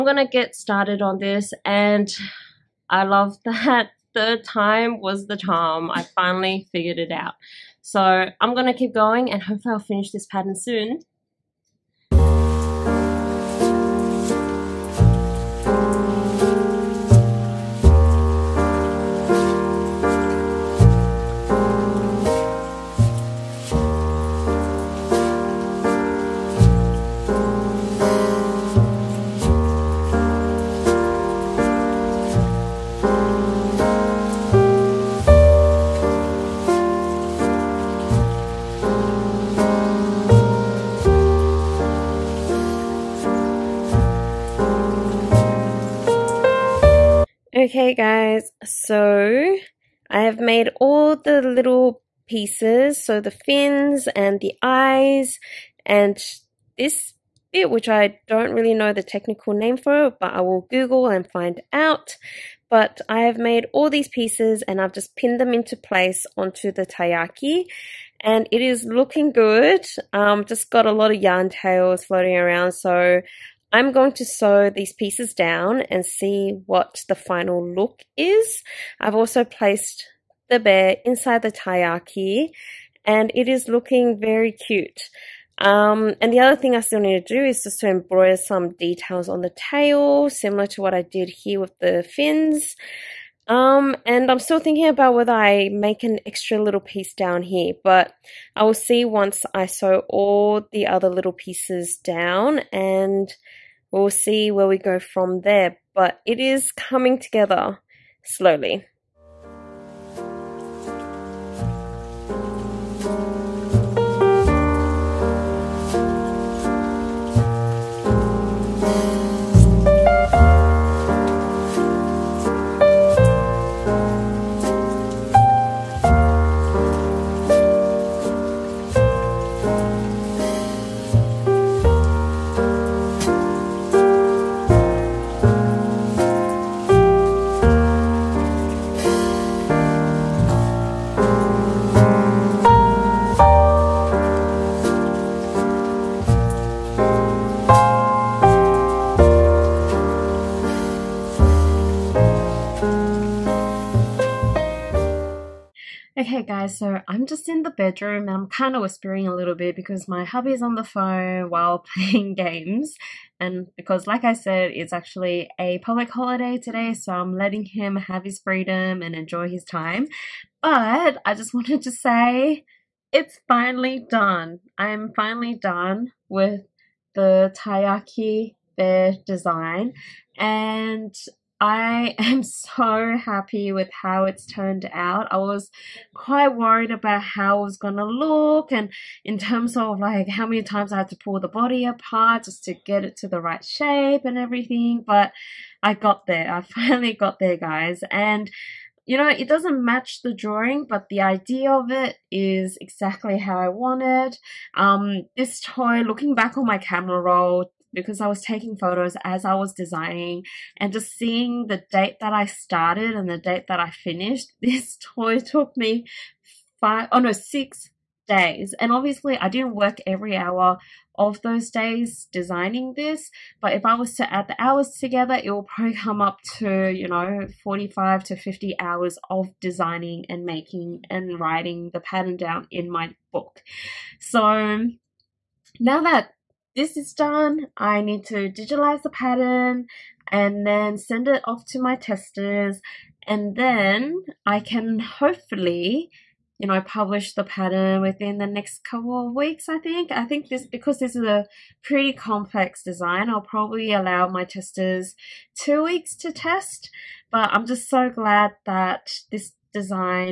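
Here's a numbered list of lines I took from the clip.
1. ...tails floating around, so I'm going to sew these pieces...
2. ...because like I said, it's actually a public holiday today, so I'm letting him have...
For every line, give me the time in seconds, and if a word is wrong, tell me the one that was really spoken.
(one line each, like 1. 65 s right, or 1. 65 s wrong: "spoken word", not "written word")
1. 71 s right
2. 163 s right.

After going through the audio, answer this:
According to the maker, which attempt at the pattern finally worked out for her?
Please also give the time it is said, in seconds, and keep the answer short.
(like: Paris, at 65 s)
Third time, at 4 s.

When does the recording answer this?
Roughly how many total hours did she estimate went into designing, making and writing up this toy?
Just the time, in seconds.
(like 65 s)
227 s.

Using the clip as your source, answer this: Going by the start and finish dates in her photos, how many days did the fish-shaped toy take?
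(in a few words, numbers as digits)
6 days.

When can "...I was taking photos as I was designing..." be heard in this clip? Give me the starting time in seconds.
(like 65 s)
208 s.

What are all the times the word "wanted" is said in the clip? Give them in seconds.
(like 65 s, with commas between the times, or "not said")
171 s, 203 s.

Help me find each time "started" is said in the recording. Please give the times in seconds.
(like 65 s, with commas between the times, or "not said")
0 s, 212 s.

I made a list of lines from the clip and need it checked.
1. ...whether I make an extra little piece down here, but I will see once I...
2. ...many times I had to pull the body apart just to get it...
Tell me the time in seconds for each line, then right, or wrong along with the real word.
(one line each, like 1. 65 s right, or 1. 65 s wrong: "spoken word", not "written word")
1. 95 s right
2. 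190 s right.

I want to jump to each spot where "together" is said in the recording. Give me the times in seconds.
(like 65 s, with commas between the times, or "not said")
107 s, 224 s.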